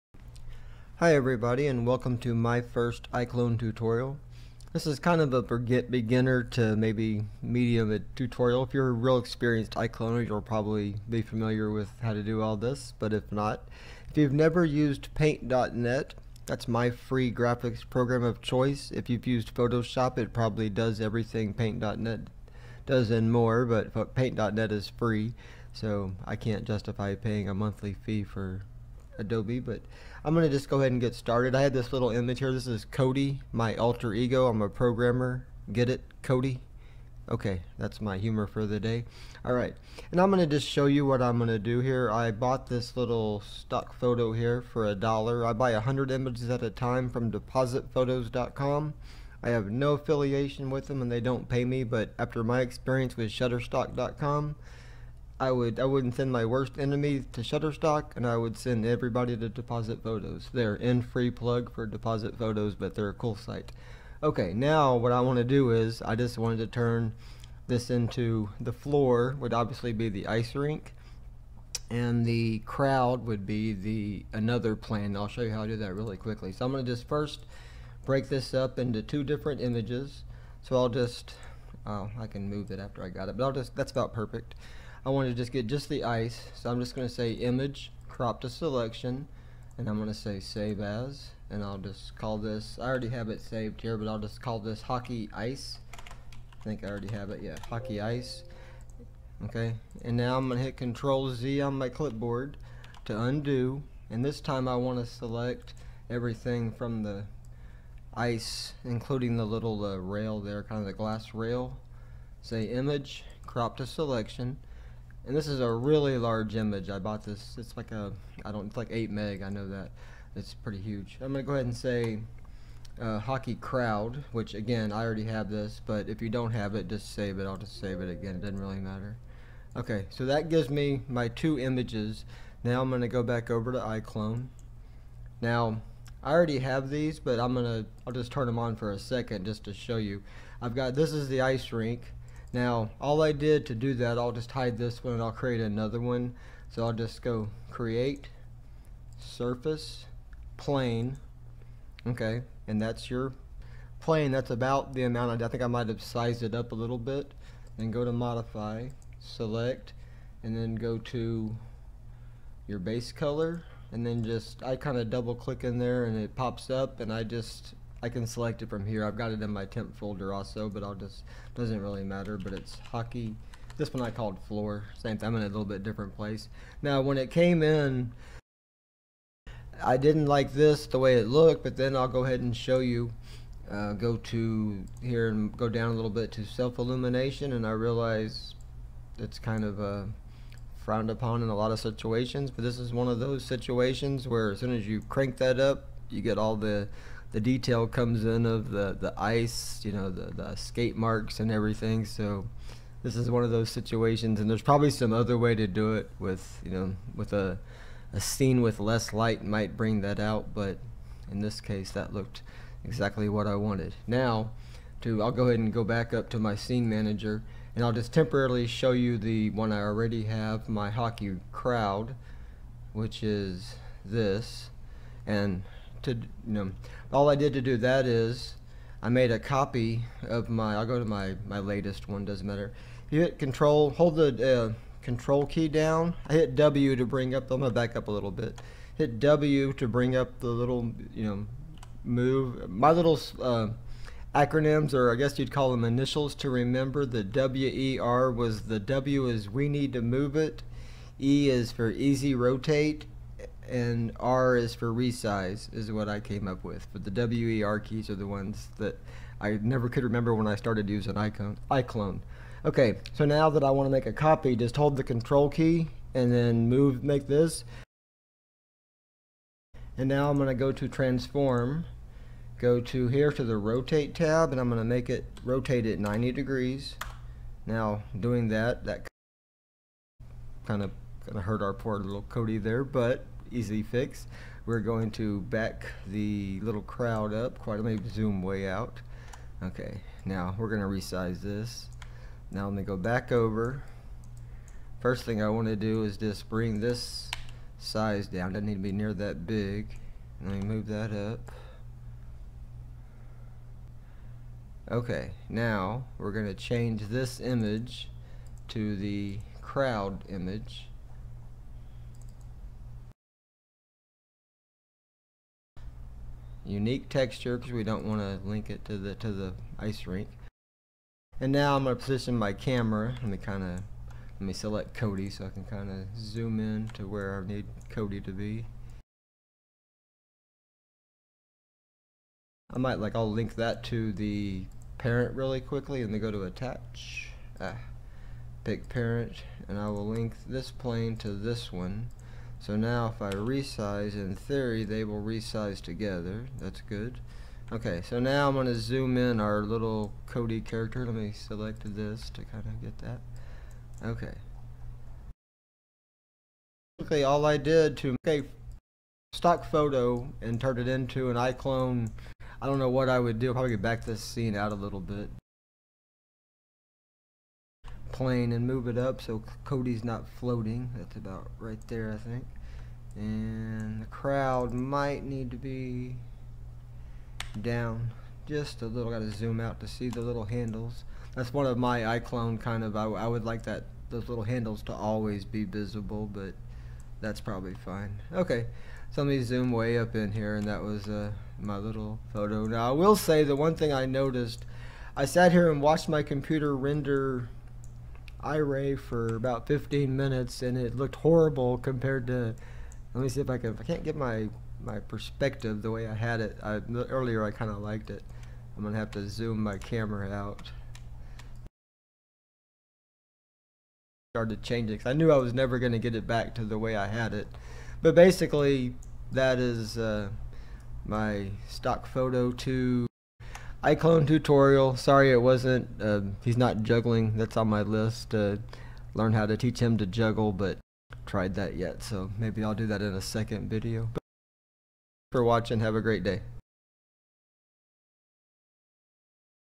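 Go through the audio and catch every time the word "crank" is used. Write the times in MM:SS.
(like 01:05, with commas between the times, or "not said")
03:15.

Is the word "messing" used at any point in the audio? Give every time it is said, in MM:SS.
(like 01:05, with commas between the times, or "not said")
not said.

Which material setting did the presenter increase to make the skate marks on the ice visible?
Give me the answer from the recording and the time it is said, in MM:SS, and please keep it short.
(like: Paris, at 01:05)
self-illumination, at 03:06.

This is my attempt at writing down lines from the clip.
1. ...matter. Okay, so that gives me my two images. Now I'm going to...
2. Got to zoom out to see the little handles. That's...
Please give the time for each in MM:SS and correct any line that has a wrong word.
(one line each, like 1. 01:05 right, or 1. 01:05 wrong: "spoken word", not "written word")
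1. 02:08 right
2. 06:19 right.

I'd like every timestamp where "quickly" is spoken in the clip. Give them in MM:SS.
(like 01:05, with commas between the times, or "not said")
01:16, 05:35.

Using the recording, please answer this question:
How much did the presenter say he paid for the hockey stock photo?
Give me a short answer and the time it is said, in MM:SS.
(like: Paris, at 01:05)
a dollar, at 00:44.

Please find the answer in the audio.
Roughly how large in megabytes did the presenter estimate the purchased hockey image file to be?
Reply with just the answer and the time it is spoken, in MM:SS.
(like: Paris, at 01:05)
8 meg, at 01:58.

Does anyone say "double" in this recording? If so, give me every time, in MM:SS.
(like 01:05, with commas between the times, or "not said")
02:45.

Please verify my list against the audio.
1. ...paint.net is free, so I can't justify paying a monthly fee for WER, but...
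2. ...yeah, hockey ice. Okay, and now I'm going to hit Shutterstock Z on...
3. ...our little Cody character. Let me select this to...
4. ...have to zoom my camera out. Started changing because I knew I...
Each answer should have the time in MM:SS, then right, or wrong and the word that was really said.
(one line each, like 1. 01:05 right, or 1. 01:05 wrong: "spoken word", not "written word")
1. 00:24 wrong: "Adobe", not "WER"
2. 01:37 wrong: "Control", not "Shutterstock"
3. 05:49 right
4. 06:48 right.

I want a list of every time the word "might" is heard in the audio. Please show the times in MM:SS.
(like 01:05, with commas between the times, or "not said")
02:35, 03:29, 05:32, 06:14.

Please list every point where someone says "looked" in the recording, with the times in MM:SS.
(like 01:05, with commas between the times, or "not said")
03:01, 03:32, 06:40.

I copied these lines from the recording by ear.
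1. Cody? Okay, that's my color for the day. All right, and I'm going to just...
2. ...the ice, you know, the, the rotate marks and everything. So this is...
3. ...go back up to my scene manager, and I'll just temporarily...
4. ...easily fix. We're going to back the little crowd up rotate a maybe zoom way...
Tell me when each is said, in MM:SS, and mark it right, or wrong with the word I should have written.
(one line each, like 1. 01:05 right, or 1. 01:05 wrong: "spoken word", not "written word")
1. 00:36 wrong: "humor", not "color"
2. 03:18 wrong: "skate", not "rotate"
3. 03:35 right
4. 04:43 wrong: "quite", not "rotate".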